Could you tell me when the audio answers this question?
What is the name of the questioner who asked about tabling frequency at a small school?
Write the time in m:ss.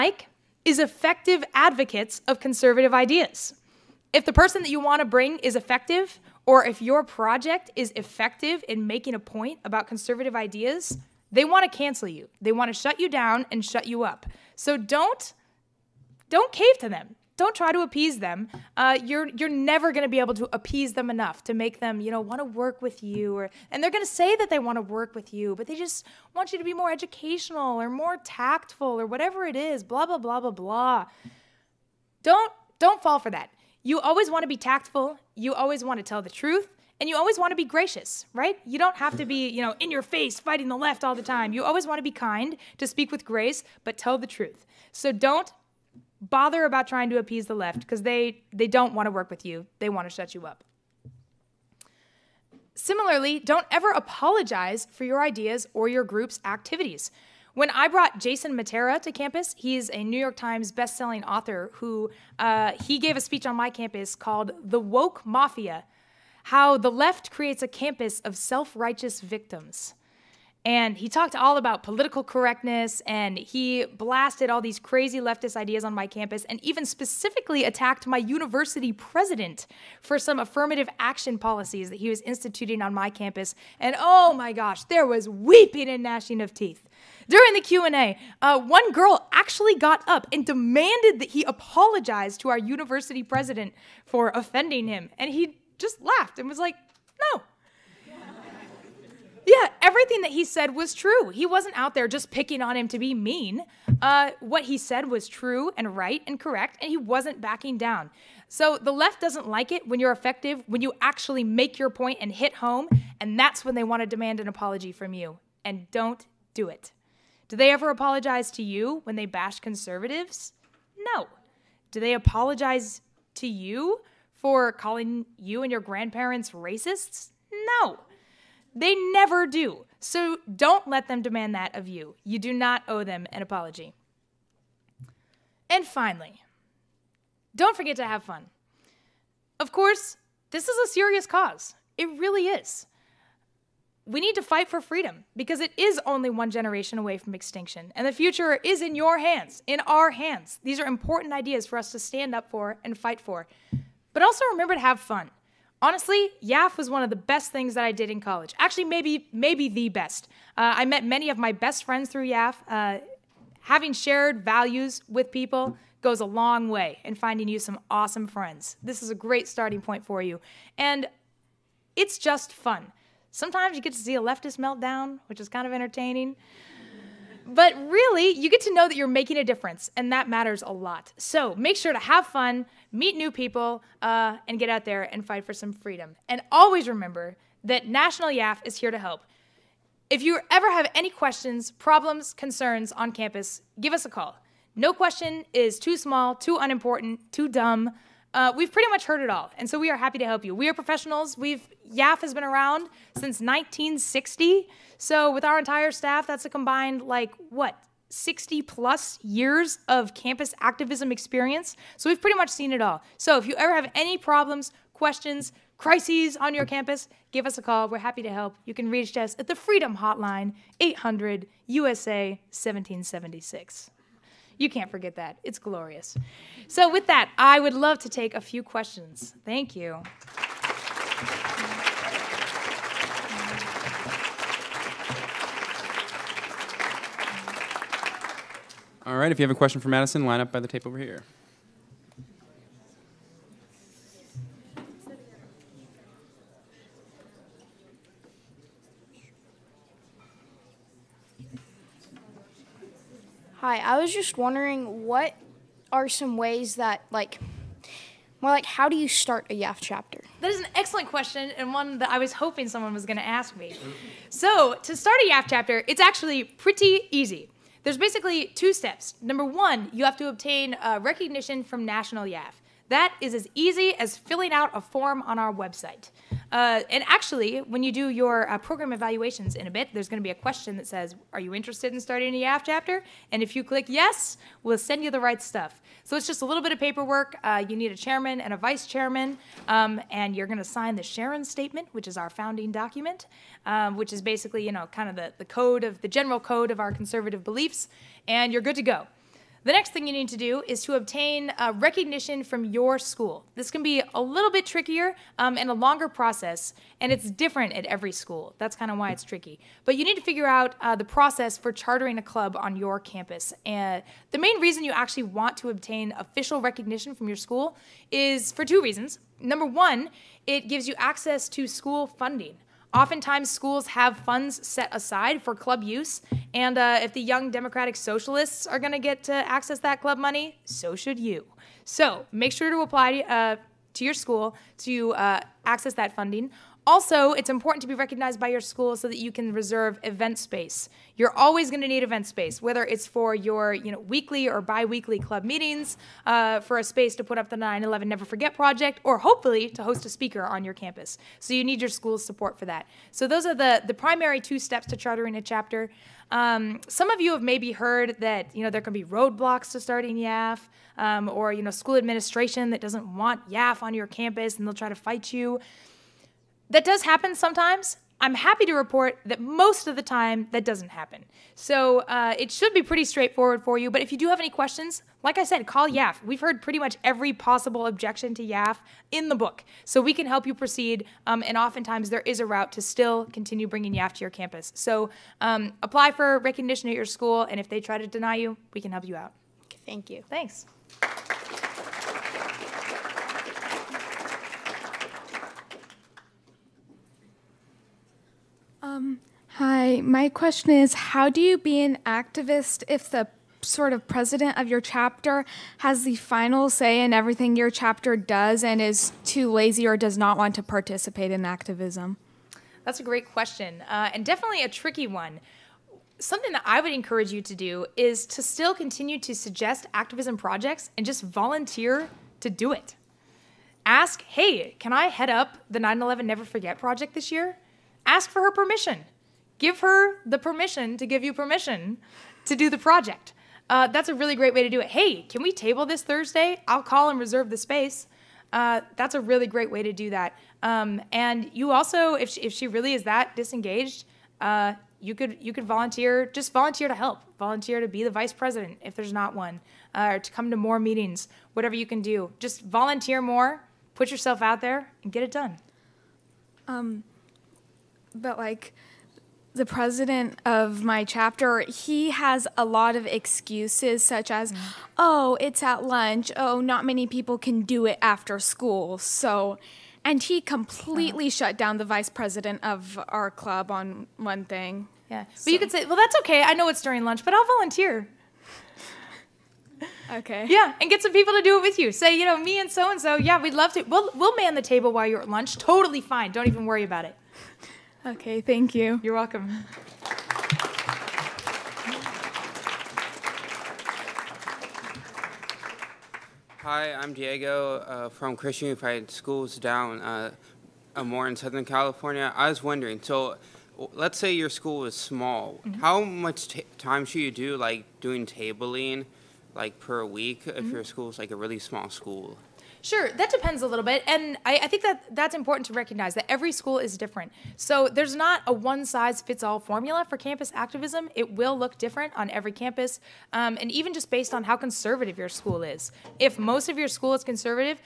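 8:17.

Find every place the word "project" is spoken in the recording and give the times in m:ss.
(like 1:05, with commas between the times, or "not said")
0:07, 5:48, 7:00, 7:06, 7:12.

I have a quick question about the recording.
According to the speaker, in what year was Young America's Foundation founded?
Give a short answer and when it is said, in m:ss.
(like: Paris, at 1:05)
1960, at 3:23.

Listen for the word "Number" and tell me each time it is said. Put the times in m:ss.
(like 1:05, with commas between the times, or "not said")
4:29, 5:19.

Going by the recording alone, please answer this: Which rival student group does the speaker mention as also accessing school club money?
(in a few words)
Young Democratic Socialists.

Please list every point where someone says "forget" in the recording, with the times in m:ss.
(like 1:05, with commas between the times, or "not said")
2:17, 3:44, 5:48, 7:06.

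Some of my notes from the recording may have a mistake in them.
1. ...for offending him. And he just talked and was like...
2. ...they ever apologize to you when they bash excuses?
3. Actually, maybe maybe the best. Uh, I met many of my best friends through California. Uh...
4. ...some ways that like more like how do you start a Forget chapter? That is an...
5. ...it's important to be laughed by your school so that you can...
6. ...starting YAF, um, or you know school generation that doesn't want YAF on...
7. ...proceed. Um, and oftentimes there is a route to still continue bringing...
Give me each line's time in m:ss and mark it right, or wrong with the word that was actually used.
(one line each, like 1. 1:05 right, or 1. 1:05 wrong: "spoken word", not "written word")
1. 1:34 wrong: "laughed", not "talked"
2. 1:57 wrong: "conservatives", not "excuses"
3. 2:38 wrong: "YAF", not "California"
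4. 4:16 wrong: "YAF", not "Forget"
5. 5:37 wrong: "recognized", not "laughed"
6. 5:59 wrong: "administration", not "generation"
7. 6:20 right.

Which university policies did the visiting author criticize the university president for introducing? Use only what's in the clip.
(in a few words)
Affirmative action.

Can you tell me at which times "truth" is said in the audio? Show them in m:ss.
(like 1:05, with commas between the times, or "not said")
0:36, 0:44.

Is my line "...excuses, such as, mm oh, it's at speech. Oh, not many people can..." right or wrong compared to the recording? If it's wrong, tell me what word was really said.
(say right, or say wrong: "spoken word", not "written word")
wrong: "lunch", not "speech".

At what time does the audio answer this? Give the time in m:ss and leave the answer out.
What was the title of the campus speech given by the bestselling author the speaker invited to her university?
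1:04.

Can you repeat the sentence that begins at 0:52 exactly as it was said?
Similarly, don't ever apologize for your ideas or your group's activities.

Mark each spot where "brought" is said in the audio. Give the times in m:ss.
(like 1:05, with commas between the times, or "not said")
0:57.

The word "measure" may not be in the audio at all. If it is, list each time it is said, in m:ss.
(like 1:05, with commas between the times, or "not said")
not said.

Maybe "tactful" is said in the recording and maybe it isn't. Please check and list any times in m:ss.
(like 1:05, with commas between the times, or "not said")
0:28, 0:34.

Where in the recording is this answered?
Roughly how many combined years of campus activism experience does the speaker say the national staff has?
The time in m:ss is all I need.
3:28.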